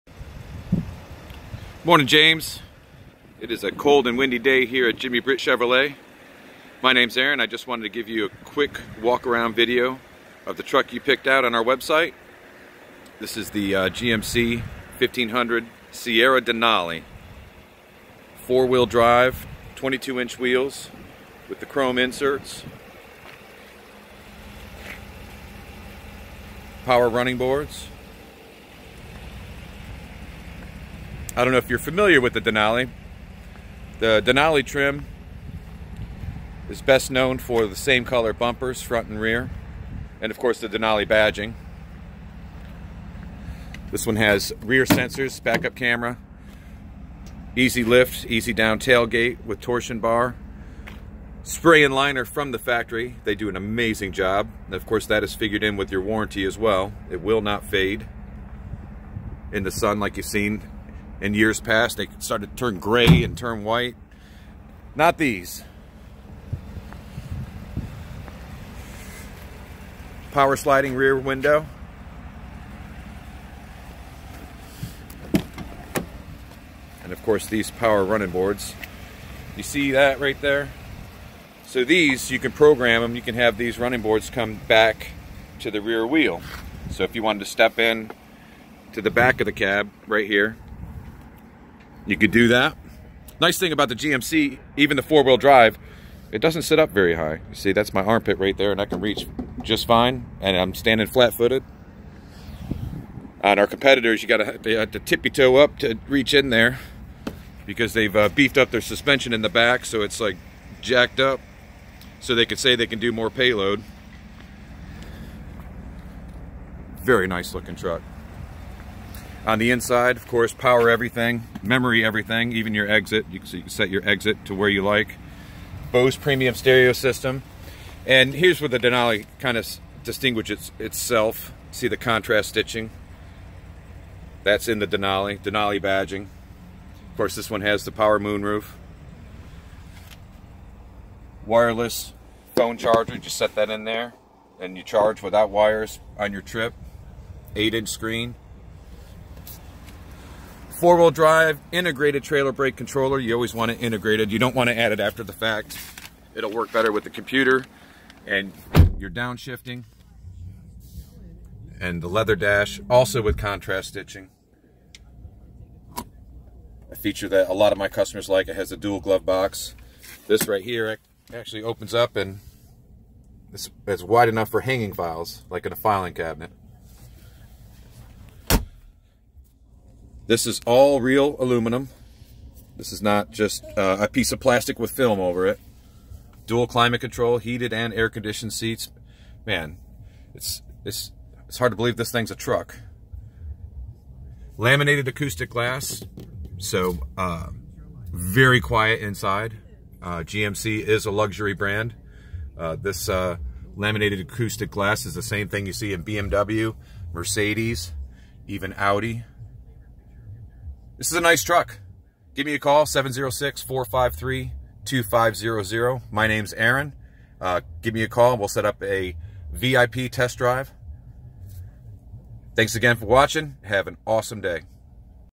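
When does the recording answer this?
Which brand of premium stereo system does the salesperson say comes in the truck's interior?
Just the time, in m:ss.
2:05.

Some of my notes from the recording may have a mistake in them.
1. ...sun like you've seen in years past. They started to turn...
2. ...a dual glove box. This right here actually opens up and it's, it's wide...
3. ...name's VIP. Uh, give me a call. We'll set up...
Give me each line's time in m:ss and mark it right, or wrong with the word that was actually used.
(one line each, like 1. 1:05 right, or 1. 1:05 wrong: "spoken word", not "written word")
1. 0:59 right
2. 2:48 right
3. 3:36 wrong: "Aaron", not "VIP".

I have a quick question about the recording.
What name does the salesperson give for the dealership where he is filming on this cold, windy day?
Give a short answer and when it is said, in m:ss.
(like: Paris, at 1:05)
Jimmy Britt Chevrolet, at 0:04.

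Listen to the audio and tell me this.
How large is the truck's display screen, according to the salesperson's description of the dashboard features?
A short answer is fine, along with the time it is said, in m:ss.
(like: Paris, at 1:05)
8 inches, at 2:27.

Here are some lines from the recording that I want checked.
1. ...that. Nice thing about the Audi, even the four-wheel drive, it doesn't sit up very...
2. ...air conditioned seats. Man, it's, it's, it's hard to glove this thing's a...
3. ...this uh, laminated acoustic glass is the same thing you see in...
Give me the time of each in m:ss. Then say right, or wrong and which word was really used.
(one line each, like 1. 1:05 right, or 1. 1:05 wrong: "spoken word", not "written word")
1. 1:32 wrong: "GMC", not "Audi"
2. 3:07 wrong: "believe", not "glove"
3. 3:22 right.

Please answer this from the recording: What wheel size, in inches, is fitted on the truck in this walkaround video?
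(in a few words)
22.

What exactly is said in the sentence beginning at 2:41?
And the leather dash, also with contrast stitching.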